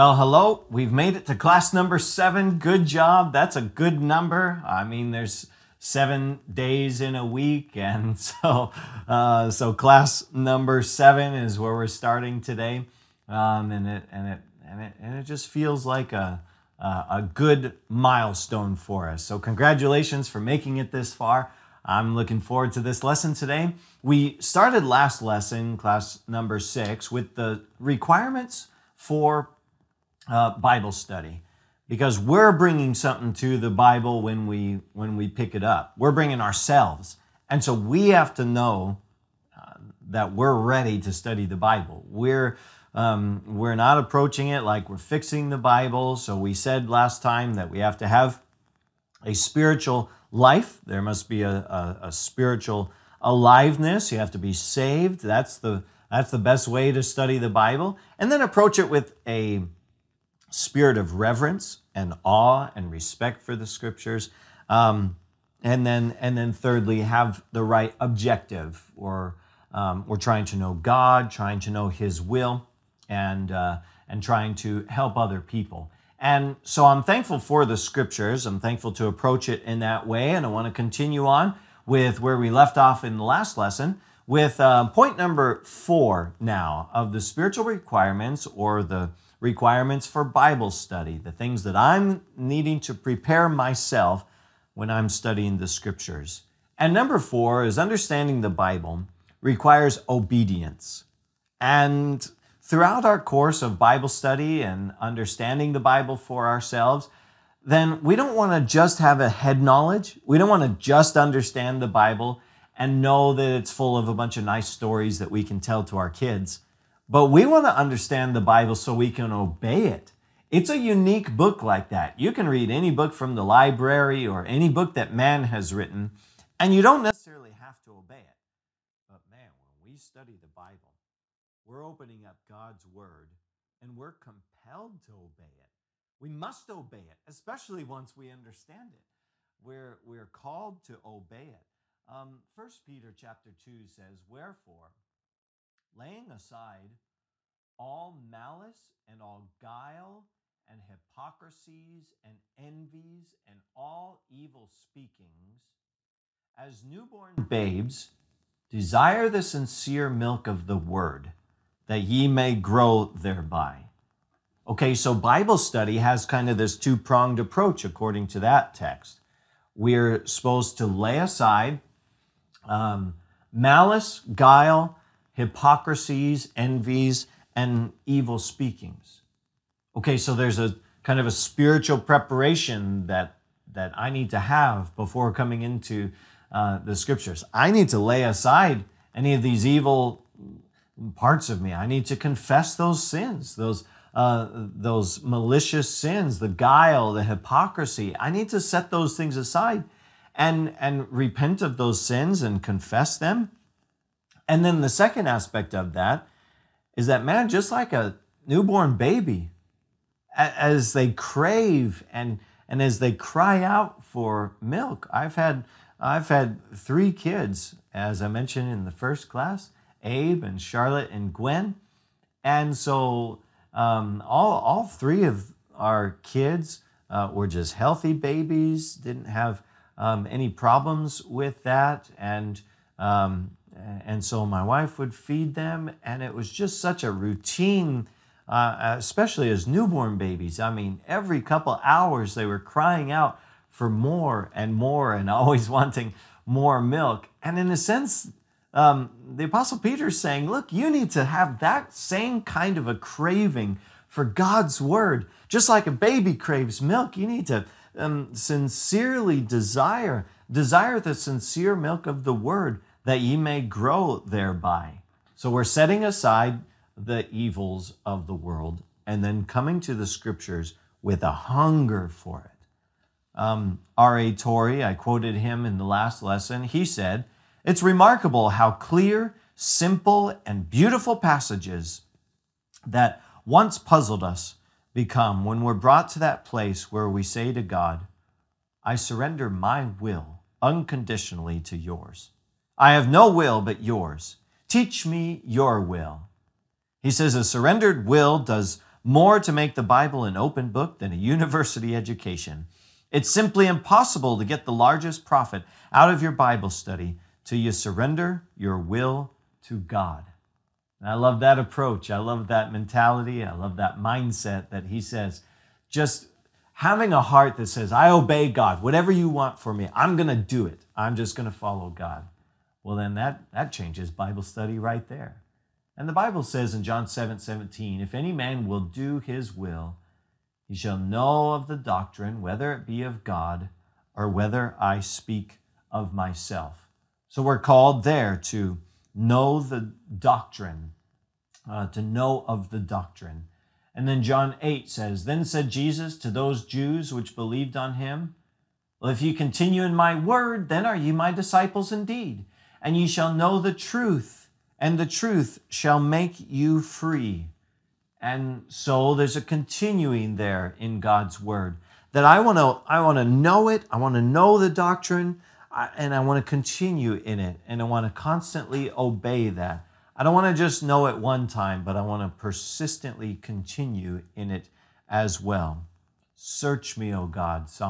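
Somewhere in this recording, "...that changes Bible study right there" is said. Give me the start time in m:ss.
5:23.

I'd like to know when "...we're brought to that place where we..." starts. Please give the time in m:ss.
4:45.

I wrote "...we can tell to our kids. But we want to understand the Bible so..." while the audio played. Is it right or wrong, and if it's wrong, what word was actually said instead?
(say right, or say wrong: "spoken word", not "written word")
right.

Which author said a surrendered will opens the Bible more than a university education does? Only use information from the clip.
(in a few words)
R.A. Torrey.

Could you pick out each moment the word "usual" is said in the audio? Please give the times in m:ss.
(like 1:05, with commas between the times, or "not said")
not said.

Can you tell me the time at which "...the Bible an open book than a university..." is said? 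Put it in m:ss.
4:59.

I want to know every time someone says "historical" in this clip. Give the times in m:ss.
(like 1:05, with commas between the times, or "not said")
not said.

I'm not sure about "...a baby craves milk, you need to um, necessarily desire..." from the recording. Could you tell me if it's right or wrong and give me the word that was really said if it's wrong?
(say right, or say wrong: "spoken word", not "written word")
wrong: "sincerely", not "necessarily".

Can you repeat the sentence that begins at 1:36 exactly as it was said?
And number four is understanding the Bible requires obedience.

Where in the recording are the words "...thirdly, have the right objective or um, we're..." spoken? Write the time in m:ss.
1:06.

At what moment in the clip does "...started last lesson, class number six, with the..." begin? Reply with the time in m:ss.
0:24.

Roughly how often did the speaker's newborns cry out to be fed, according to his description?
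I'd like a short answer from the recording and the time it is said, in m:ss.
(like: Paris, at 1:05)
Every couple hours, at 4:01.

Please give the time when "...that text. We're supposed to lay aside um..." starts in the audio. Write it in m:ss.
2:48.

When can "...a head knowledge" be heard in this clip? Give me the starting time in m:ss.
1:49.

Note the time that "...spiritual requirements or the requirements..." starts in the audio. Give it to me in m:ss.
1:27.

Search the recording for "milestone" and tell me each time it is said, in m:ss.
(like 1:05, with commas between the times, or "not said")
0:17.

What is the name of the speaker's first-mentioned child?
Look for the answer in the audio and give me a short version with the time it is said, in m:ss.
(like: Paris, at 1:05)
Abe, at 3:40.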